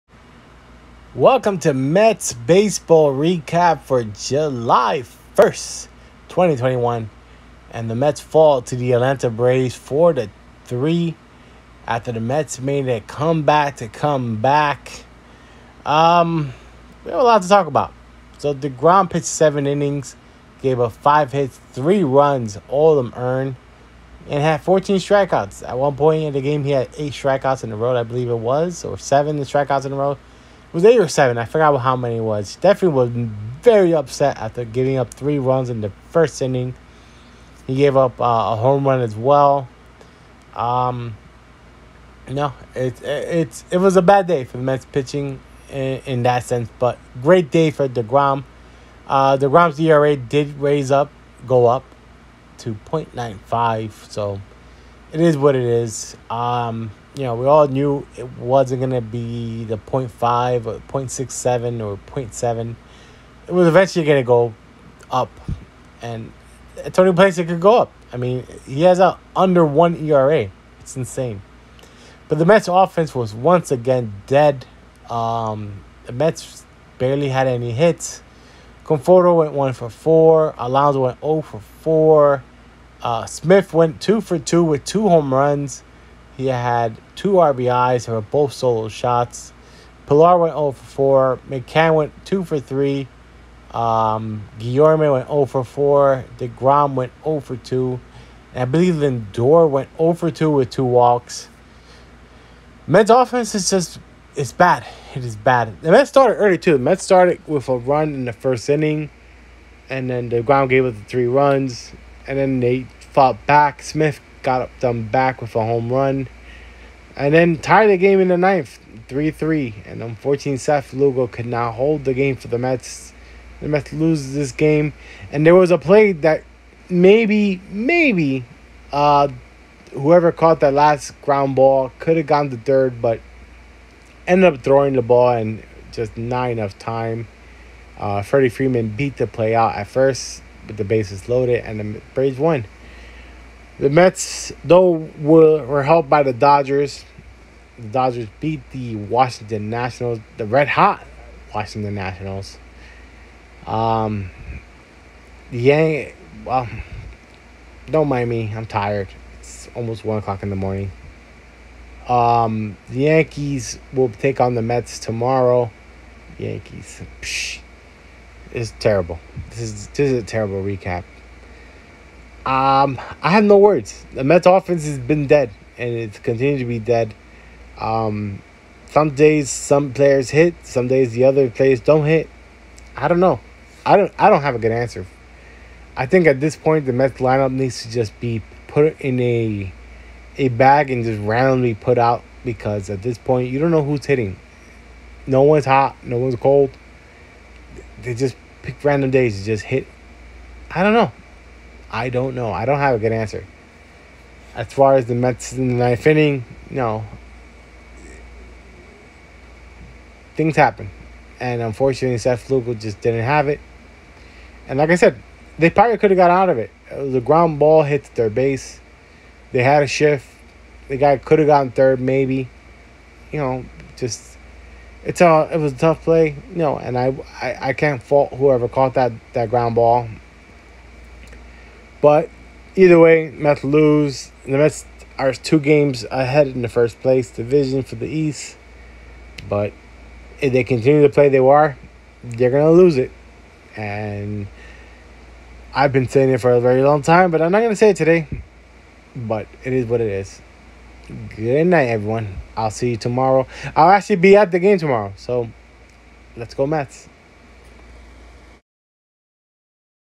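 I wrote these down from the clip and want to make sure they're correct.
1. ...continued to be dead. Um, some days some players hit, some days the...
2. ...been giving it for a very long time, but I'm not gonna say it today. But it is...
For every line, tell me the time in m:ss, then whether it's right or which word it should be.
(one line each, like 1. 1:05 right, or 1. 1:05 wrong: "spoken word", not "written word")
1. 2:56 right
2. 4:05 wrong: "saying", not "giving".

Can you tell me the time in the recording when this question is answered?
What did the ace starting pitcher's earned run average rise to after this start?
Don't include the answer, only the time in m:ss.
0:52.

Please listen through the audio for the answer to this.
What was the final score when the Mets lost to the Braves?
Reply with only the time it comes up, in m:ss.
0:09.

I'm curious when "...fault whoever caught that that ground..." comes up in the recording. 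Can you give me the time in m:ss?
3:48.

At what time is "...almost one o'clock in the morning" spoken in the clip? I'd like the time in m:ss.
2:39.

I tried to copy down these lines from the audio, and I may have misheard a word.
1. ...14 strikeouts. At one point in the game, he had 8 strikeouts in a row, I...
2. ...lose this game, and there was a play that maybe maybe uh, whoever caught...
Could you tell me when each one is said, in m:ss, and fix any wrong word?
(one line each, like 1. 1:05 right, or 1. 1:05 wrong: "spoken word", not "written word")
1. 0:24 right
2. 2:03 right.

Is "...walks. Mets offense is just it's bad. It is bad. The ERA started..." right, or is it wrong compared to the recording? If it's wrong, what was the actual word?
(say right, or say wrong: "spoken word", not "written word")
wrong: "Mets", not "ERA".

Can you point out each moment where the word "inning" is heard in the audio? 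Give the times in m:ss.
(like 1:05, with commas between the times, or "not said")
0:19, 0:36, 1:48, 3:26.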